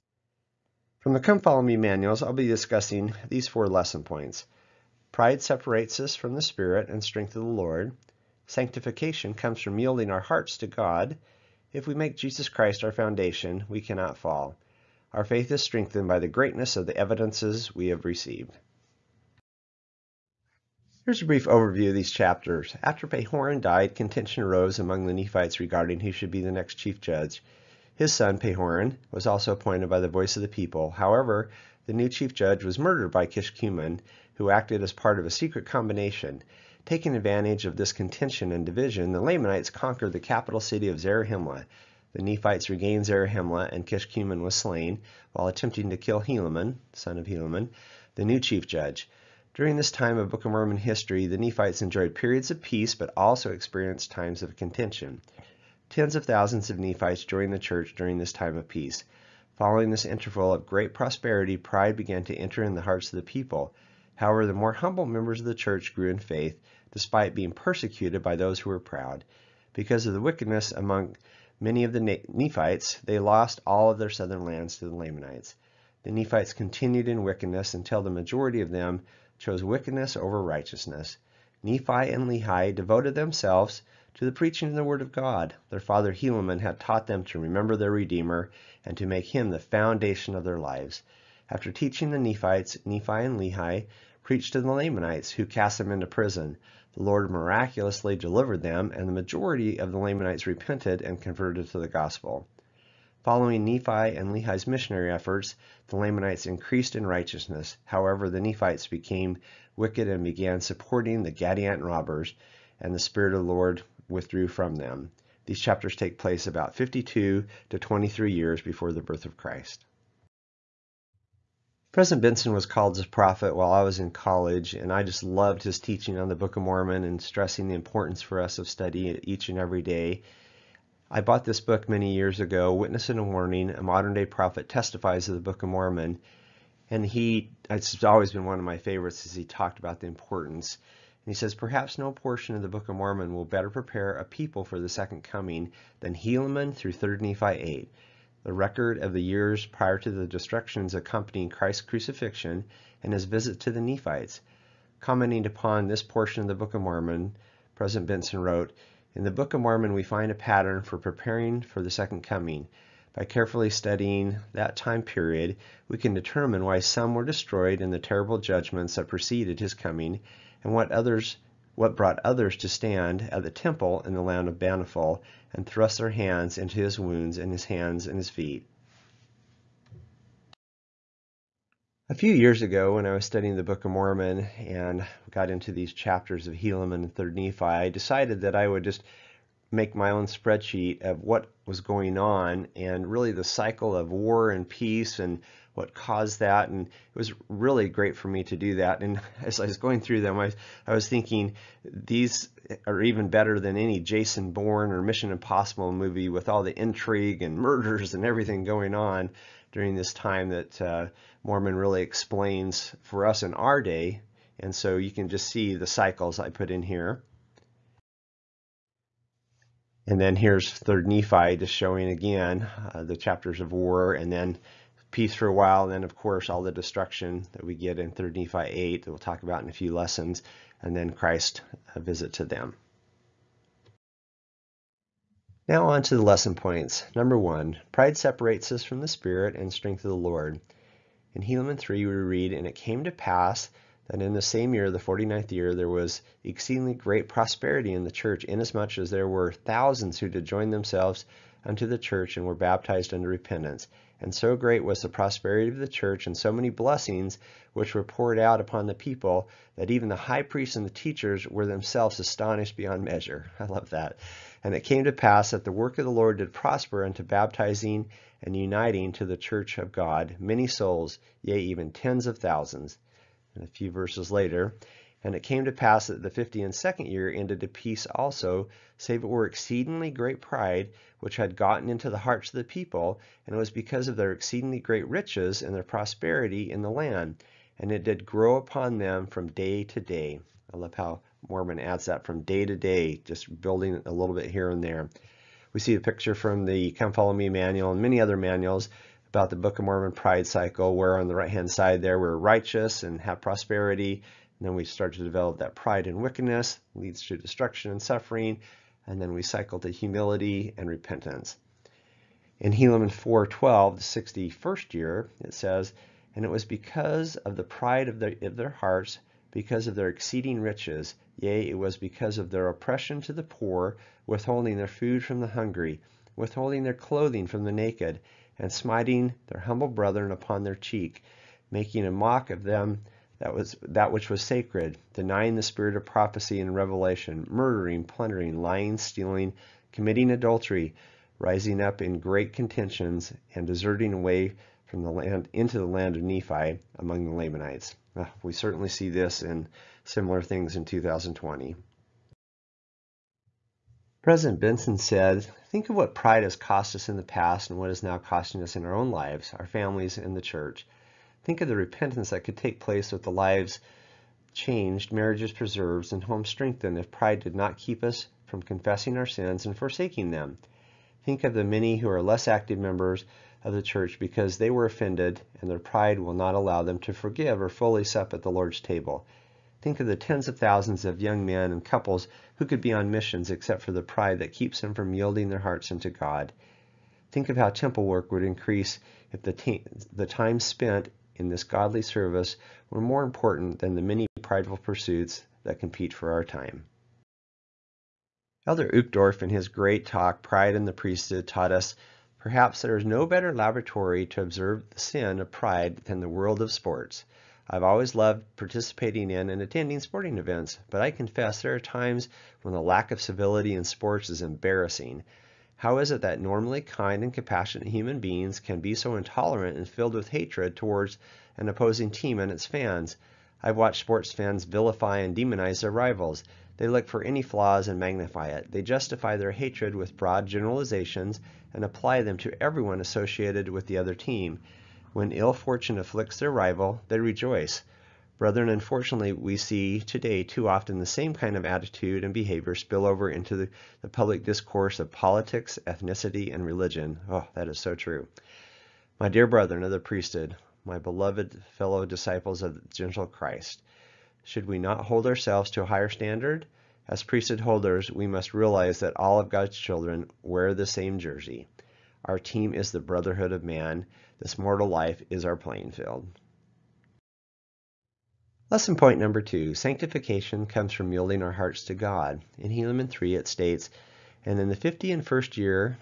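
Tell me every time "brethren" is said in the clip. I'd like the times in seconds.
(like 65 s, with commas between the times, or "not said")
329 s, 438 s, 449 s.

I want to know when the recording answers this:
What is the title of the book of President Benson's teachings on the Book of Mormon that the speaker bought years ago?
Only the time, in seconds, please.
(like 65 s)
132 s.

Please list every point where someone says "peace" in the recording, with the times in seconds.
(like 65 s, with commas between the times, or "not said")
52 s, 58 s, 194 s, 225 s, 277 s.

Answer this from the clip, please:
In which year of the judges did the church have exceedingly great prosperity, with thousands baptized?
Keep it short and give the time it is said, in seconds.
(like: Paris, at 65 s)
49th year, at 244 s.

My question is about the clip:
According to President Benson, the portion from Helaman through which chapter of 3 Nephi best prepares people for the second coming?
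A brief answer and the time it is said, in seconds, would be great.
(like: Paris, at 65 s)
3 Nephi 8, at 146 s.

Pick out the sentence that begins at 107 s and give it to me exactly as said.
However, the Nephites became wicked and began supporting the Gadianton robbers, and the Spirit of the Lord withdrew from them.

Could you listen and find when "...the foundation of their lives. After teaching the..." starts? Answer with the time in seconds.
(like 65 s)
89 s.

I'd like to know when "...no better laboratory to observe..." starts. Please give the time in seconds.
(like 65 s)
403 s.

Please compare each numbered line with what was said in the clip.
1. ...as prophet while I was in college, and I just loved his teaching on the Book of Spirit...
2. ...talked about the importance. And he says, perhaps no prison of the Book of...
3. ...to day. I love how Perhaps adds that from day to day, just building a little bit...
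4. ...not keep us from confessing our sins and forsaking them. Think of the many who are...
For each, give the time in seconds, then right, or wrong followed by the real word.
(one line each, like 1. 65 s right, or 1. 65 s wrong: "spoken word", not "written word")
1. 122 s wrong: "Mormon", not "Spirit"
2. 139 s wrong: "portion", not "prison"
3. 289 s wrong: "Mormon", not "Perhaps"
4. 367 s right.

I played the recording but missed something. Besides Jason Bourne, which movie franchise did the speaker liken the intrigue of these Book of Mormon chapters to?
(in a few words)
Mission Impossible.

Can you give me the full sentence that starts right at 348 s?
Uh, we certainly see this in similar things in 2020.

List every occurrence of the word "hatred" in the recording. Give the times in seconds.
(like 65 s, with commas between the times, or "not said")
420 s, 429 s.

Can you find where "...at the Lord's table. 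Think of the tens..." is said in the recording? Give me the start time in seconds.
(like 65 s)
378 s.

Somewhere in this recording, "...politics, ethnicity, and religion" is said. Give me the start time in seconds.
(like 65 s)
445 s.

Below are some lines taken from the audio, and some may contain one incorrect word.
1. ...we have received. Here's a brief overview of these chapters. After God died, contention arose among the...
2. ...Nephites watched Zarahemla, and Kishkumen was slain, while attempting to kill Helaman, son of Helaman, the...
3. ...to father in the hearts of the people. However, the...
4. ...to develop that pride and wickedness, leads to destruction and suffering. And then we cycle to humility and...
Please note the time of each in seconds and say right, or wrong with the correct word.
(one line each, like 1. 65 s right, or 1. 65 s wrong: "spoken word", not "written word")
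1. 17 s wrong: "Pahoran", not "God"
2. 42 s wrong: "regained", not "watched"
3. 62 s wrong: "enter", not "father"
4. 305 s right.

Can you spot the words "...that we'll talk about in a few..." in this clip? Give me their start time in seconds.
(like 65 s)
229 s.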